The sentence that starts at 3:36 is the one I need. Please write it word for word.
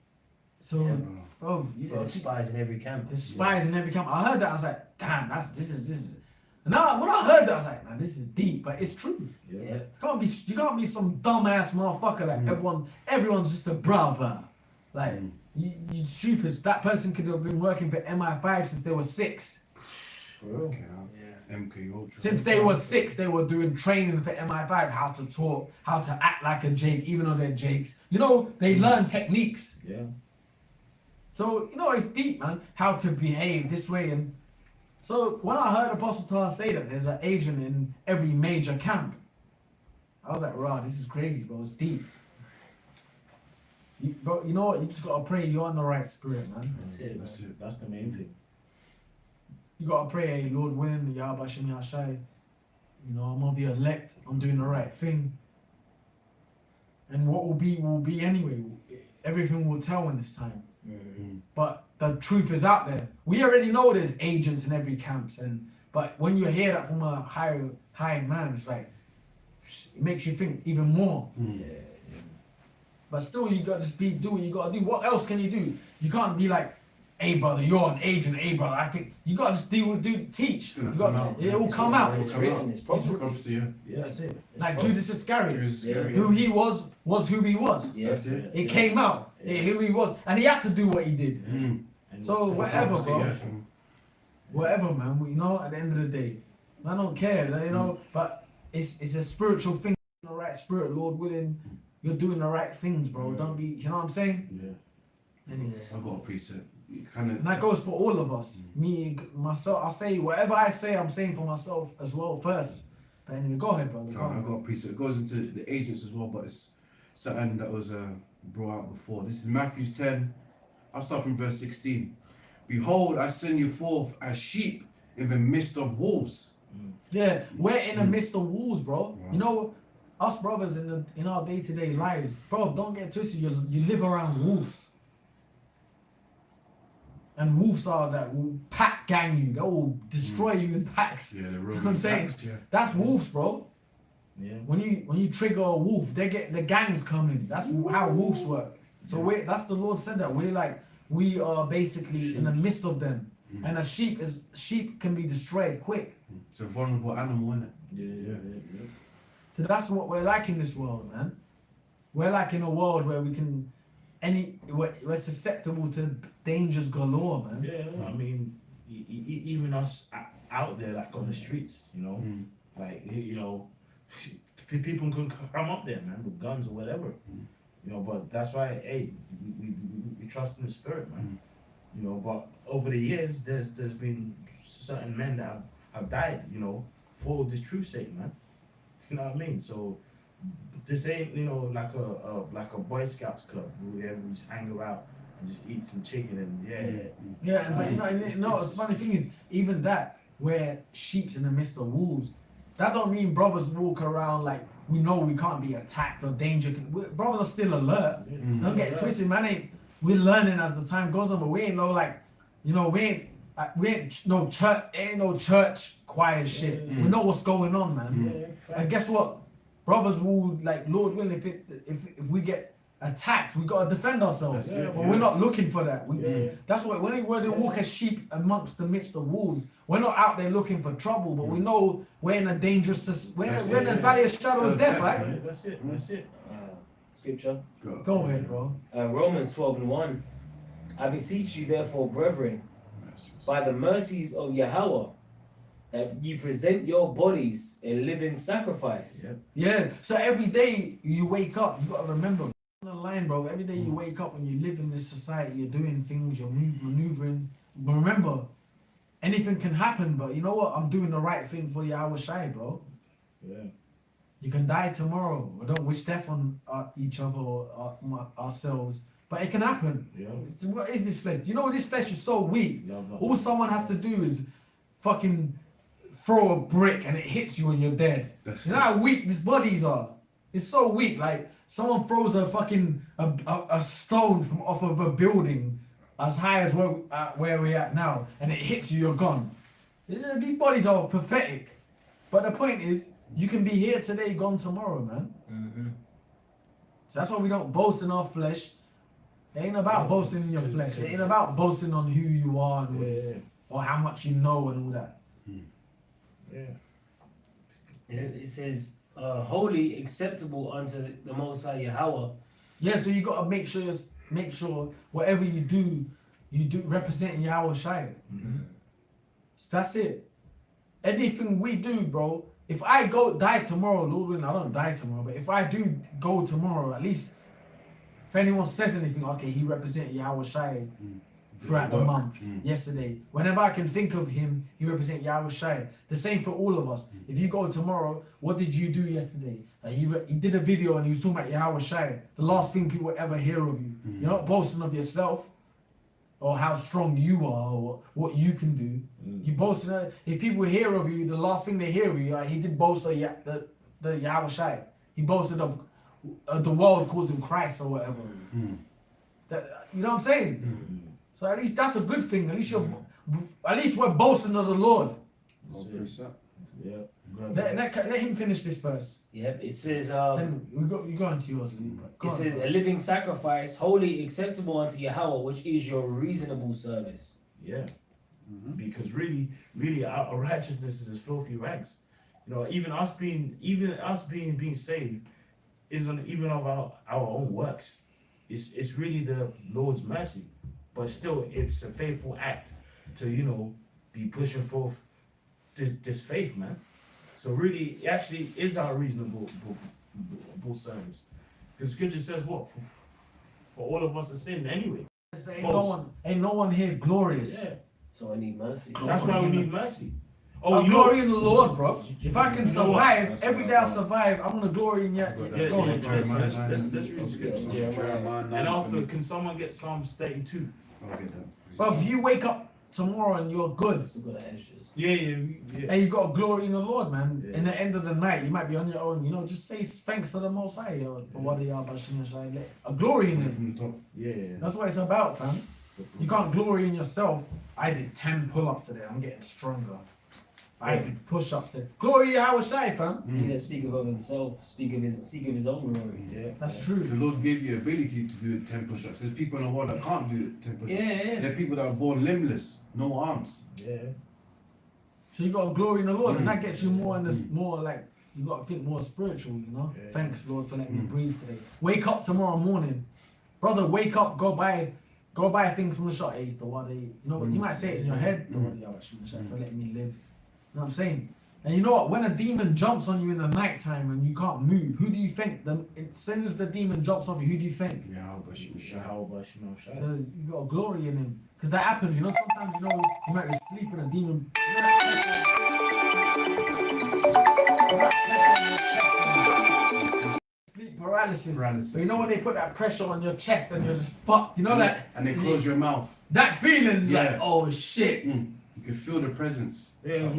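We know what's going on, man.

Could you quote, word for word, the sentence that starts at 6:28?
It's it's really the Lord's mercy.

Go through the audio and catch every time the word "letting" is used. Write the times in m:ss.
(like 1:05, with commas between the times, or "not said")
7:40, 7:49.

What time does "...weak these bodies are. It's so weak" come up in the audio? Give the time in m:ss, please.
4:38.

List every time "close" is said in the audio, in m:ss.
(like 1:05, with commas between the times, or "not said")
8:15.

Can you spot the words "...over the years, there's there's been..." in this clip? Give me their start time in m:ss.
3:02.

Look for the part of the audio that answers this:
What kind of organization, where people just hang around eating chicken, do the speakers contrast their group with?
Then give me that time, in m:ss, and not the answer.
3:12.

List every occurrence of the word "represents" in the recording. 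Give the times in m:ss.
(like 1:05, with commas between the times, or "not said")
5:16, 5:29, 5:34.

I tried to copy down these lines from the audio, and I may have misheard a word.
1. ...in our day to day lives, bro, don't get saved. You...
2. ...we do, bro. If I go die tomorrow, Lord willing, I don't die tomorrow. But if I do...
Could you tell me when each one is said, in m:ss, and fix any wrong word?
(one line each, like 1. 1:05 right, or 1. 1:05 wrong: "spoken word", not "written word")
1. 2:11 wrong: "twisted", not "saved"
2. 5:21 right.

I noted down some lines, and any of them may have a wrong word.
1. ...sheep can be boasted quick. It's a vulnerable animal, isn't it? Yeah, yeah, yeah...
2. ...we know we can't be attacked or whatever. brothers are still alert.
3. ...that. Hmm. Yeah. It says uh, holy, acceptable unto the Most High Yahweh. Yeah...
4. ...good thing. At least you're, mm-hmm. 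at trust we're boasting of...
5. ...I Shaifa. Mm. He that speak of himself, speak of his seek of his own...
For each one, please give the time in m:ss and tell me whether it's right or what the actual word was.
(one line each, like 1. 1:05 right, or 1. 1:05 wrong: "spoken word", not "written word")
1. 2:34 wrong: "destroyed", not "boasted"
2. 3:24 wrong: "danger", not "whatever"
3. 5:05 right
4. 6:02 wrong: "least", not "trust"
5. 7:22 right.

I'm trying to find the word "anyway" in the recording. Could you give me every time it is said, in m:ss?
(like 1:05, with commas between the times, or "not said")
0:58, 1:53, 6:44.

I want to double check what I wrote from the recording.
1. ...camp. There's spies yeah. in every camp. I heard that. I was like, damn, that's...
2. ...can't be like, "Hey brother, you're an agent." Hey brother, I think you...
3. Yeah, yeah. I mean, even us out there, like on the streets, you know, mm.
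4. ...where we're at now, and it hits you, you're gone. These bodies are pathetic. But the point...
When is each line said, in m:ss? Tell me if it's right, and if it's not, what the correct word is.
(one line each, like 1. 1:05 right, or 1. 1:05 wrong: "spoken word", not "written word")
1. 0:02 right
2. 1:16 right
3. 2:47 right
4. 4:47 right.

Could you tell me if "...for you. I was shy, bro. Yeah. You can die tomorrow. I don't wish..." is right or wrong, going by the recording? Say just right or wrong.
right.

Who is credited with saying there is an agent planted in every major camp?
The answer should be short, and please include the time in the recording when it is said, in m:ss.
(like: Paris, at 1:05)
Apostle Tahar, at 0:35.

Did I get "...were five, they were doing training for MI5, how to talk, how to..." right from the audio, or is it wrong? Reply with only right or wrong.
wrong.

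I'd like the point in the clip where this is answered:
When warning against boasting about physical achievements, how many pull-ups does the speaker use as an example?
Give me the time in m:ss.
7:18.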